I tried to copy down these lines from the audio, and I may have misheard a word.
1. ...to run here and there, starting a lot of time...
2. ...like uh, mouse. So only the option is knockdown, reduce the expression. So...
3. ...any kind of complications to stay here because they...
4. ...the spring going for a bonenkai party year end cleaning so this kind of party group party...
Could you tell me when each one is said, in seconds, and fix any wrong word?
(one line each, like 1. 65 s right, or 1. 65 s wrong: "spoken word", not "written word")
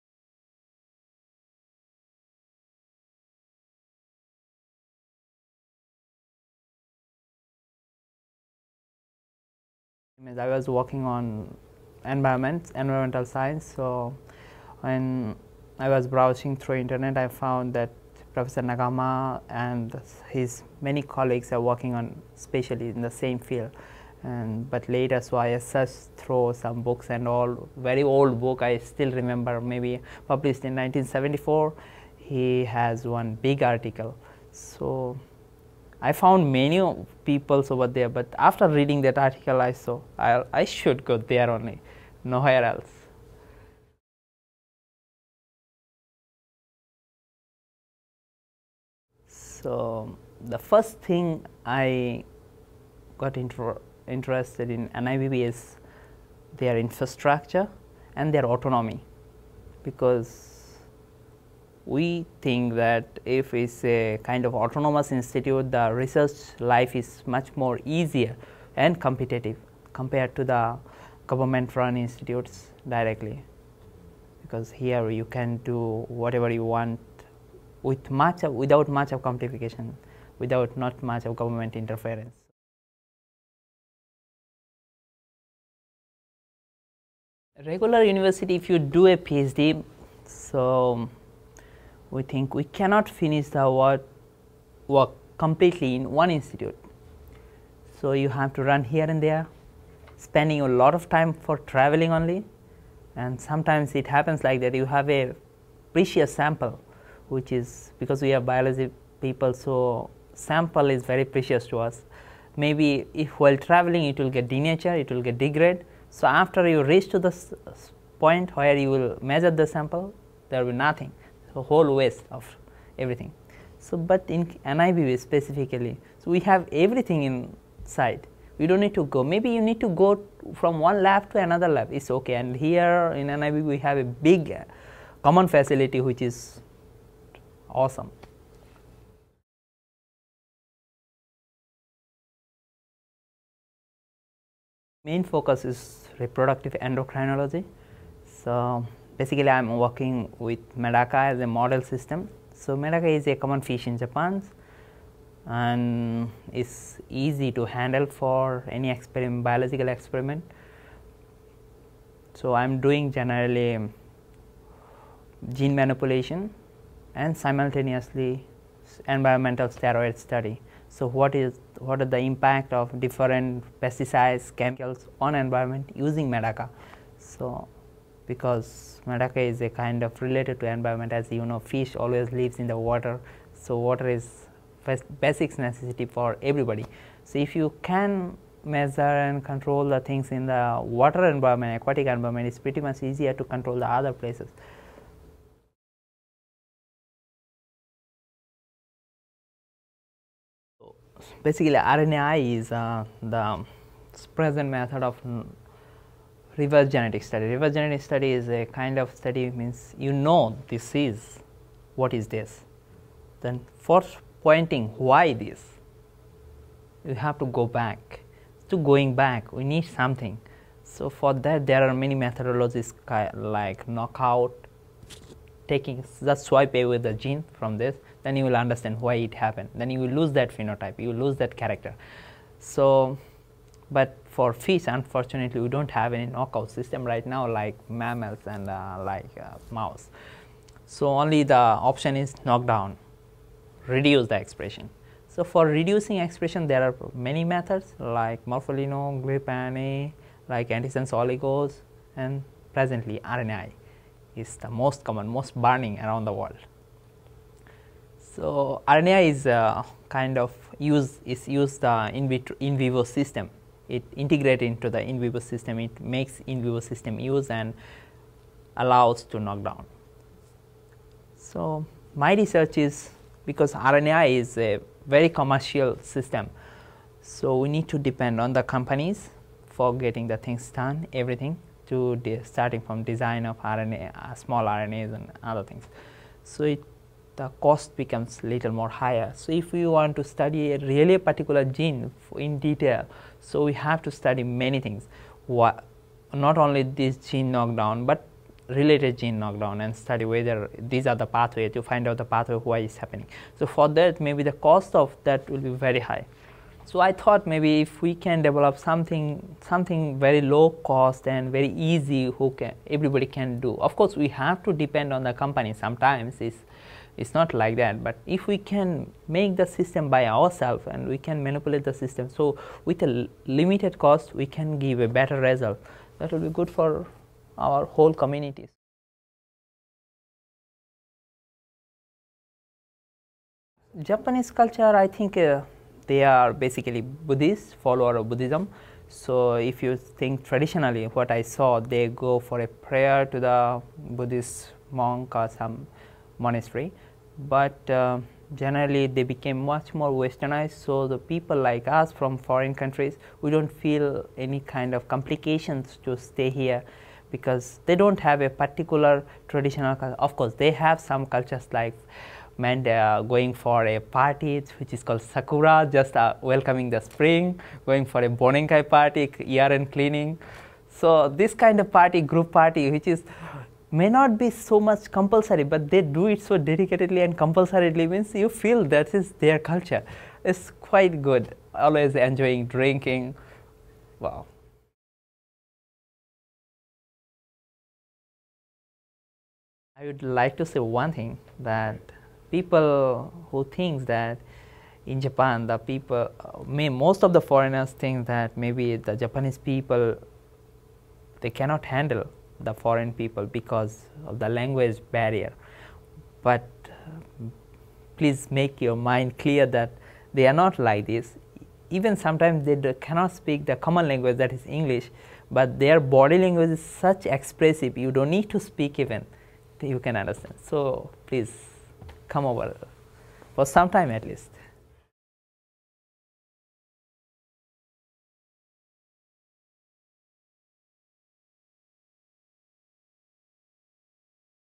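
1. 98 s wrong: "spending", not "starting"
2. 239 s right
3. 354 s right
4. 366 s right.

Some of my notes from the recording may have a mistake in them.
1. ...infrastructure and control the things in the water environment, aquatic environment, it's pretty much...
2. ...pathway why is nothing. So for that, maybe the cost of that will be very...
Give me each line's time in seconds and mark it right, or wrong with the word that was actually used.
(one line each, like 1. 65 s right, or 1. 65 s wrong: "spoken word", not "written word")
1. 188 s wrong: "measure", not "infrastructure"
2. 302 s wrong: "happening", not "nothing".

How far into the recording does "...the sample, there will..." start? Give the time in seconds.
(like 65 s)
119 s.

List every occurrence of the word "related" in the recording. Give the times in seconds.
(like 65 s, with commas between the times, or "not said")
180 s, 298 s.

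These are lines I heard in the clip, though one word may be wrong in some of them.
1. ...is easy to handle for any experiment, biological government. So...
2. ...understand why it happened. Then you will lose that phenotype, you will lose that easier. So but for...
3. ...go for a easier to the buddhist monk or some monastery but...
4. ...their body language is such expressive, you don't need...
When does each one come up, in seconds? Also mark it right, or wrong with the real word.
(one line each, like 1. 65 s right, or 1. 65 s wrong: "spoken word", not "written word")
1. 156 s wrong: "experiment", not "government"
2. 228 s wrong: "character", not "easier"
3. 342 s wrong: "prayer", not "easier"
4. 415 s right.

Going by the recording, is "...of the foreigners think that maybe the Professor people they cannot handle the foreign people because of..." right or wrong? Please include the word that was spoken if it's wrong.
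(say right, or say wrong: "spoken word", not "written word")
wrong: "Japanese", not "Professor".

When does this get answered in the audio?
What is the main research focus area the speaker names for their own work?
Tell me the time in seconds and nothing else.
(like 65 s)
146 s.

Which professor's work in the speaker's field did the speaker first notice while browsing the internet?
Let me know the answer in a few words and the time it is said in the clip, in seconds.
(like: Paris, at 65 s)
Nagahama, at 18 s.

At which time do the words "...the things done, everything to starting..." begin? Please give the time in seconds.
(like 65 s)
280 s.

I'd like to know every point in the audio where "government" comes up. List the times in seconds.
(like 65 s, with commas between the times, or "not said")
71 s, 81 s.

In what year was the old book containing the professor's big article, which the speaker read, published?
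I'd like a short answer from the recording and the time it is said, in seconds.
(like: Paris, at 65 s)
1974, at 30 s.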